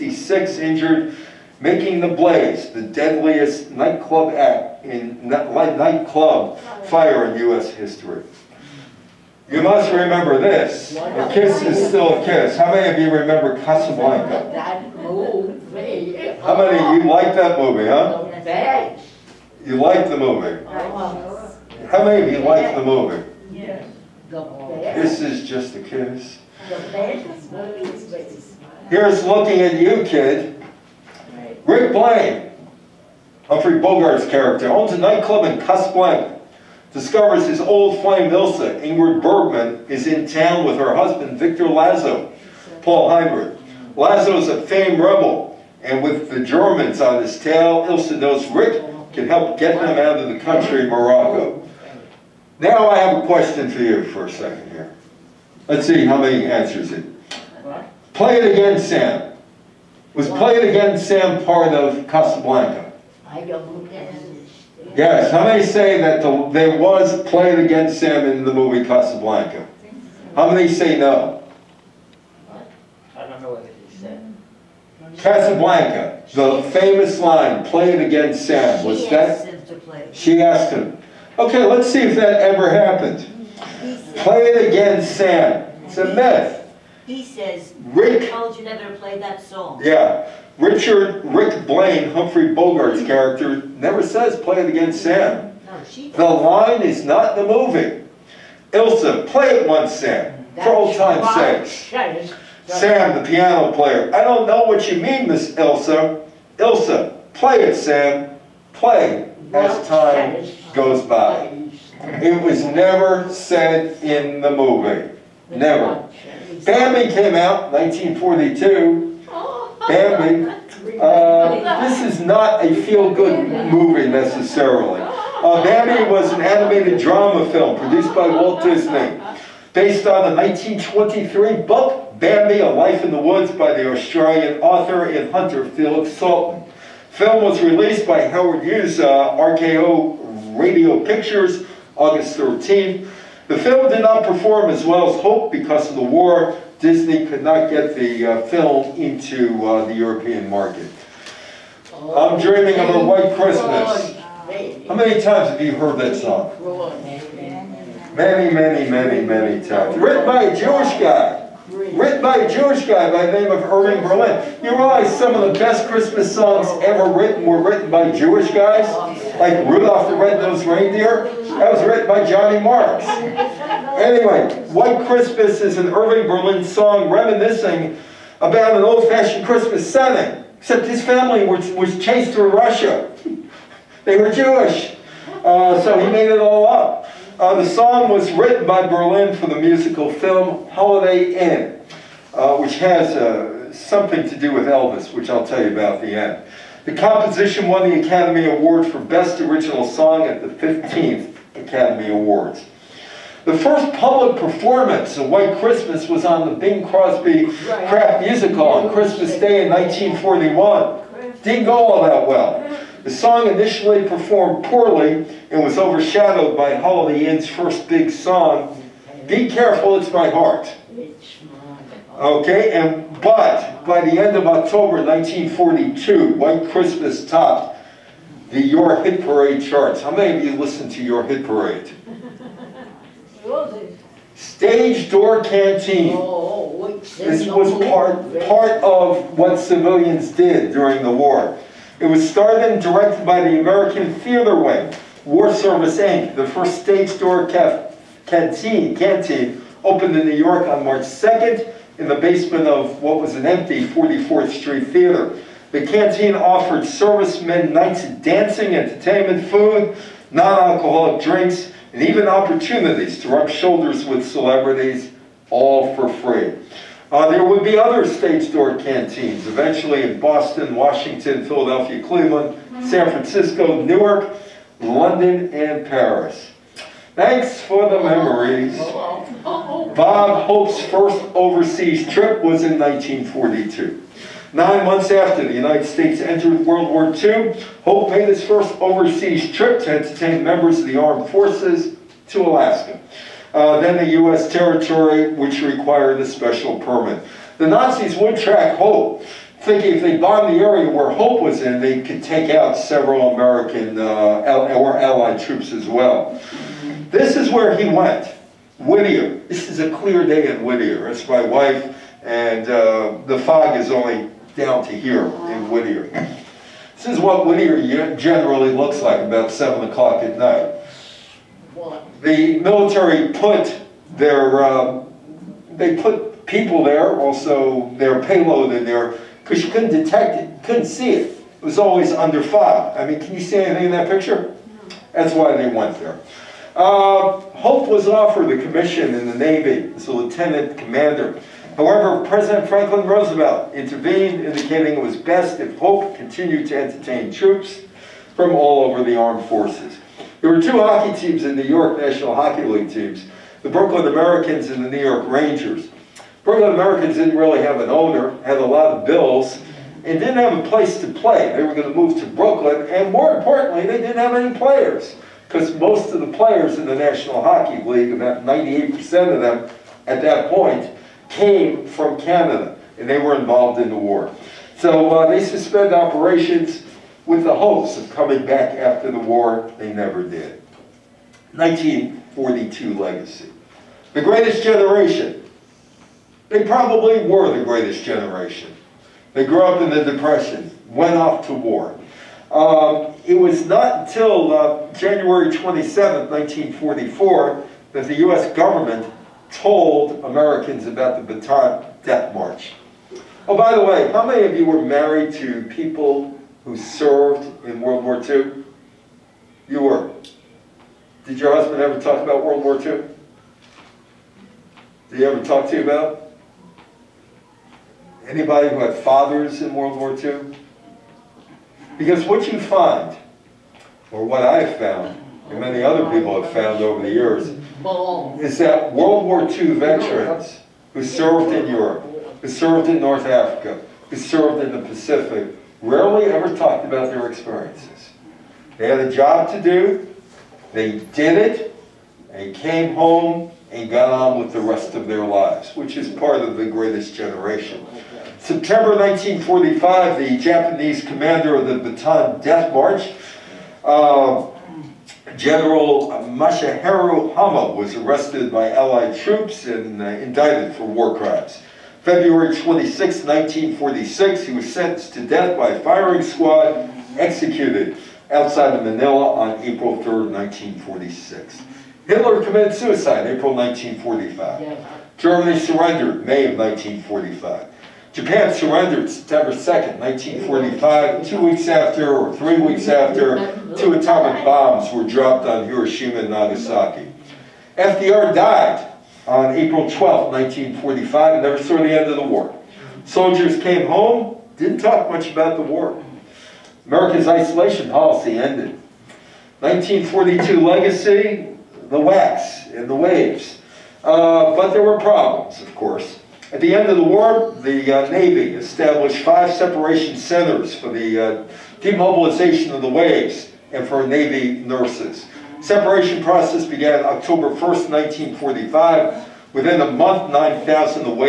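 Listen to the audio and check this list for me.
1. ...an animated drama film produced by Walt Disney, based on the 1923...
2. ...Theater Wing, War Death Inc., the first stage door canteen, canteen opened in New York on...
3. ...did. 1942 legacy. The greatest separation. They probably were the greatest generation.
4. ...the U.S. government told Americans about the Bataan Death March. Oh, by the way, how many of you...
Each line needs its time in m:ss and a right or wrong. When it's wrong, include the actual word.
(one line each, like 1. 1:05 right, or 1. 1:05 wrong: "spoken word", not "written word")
1. 2:06 right
2. 4:04 wrong: "Service", not "Death"
3. 6:20 wrong: "generation", not "separation"
4. 6:38 right.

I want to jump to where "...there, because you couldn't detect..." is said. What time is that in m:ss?
5:28.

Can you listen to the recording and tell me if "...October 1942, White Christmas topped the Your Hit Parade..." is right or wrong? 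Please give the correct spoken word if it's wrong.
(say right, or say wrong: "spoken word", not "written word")
right.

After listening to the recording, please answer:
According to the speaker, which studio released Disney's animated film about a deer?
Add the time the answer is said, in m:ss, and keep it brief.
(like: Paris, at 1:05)
RKO Radio Pictures, at 2:19.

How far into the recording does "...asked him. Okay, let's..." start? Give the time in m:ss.
1:20.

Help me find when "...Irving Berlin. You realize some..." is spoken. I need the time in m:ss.
2:43.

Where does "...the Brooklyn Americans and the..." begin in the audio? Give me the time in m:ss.
5:53.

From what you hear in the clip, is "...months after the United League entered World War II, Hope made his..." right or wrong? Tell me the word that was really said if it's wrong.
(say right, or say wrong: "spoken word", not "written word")
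wrong: "States", not "League".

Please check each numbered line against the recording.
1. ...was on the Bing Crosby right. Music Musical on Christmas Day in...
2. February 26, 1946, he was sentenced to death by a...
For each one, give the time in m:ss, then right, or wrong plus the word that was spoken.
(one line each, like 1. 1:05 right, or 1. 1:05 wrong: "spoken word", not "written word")
1. 3:26 right
2. 7:42 right.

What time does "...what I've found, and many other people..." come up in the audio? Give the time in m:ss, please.
7:04.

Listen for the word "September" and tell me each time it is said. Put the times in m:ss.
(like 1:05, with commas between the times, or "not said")
7:28, 7:59.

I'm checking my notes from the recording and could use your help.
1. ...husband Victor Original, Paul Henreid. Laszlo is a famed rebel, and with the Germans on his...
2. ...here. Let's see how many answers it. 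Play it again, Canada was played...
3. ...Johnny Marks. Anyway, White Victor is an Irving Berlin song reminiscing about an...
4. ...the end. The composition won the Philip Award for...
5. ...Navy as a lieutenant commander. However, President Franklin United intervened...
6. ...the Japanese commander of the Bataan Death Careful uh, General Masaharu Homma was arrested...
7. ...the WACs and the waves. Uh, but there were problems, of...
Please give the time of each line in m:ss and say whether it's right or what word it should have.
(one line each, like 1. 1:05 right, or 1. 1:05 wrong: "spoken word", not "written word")
1. 0:40 wrong: "Laszlo", not "Original"
2. 0:54 wrong: "Sam", not "Canada"
3. 2:52 wrong: "Christmas", not "Victor"
4. 3:16 wrong: "Academy", not "Philip"
5. 5:39 wrong: "Roosevelt", not "United"
6. 7:30 wrong: "March", not "Careful"
7. 8:21 right.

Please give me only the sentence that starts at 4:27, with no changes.
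Uh, there would be other stage door canteens, eventually in Boston, Washington, Philadelphia, Cleveland, San Francisco, Newark, London, and Paris.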